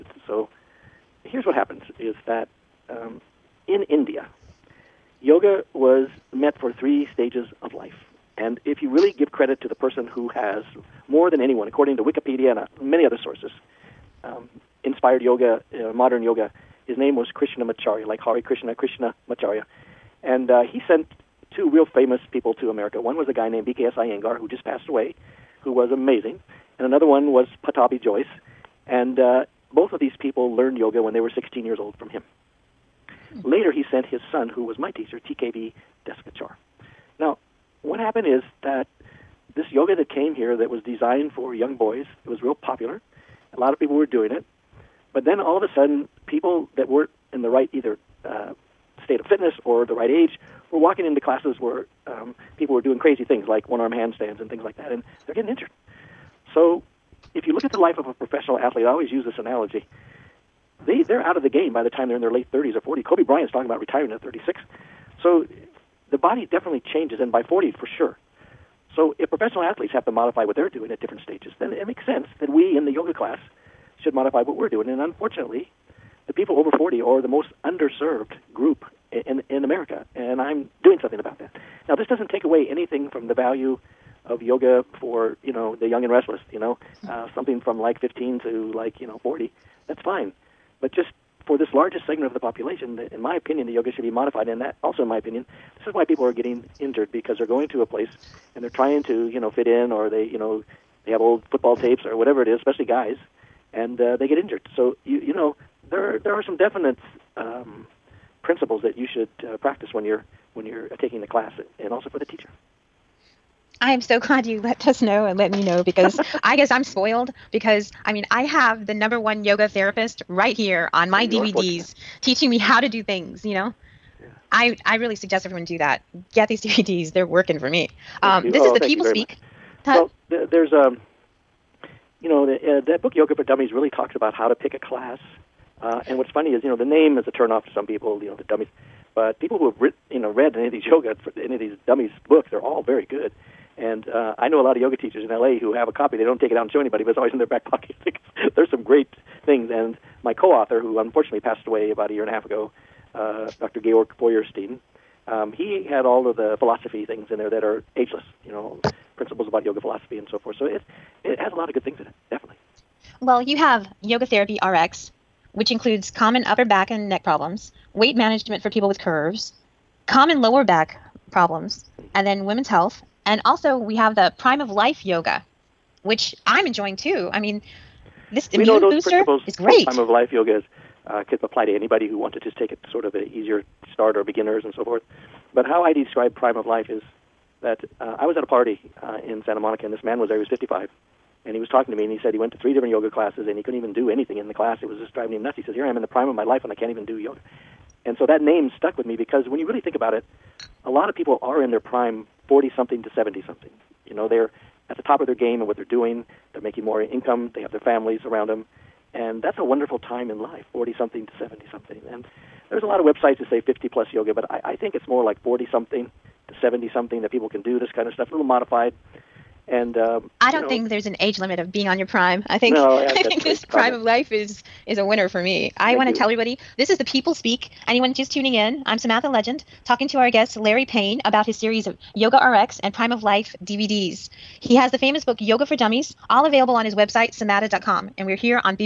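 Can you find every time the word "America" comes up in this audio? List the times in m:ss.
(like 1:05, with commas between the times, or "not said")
0:22, 1:19.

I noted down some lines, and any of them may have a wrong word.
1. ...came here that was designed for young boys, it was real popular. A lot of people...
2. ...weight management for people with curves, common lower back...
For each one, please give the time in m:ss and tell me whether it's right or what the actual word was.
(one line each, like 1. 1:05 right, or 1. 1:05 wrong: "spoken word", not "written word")
1. 0:40 right
2. 2:47 right.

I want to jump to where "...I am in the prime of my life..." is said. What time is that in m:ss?
3:15.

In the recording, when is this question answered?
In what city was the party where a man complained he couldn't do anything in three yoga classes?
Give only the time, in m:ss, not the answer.
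3:09.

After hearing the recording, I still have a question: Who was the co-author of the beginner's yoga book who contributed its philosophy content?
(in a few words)
Georg Feuerstein.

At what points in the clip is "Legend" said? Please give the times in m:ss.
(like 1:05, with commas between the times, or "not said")
3:49.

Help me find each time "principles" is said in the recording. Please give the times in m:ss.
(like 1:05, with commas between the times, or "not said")
1:48, 2:39.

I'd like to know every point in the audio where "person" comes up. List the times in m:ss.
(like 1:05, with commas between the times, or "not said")
0:09.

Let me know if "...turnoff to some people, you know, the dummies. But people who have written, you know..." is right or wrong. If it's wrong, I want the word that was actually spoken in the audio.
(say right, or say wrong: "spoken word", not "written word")
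right.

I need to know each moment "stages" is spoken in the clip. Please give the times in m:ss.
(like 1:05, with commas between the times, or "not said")
0:07, 1:11.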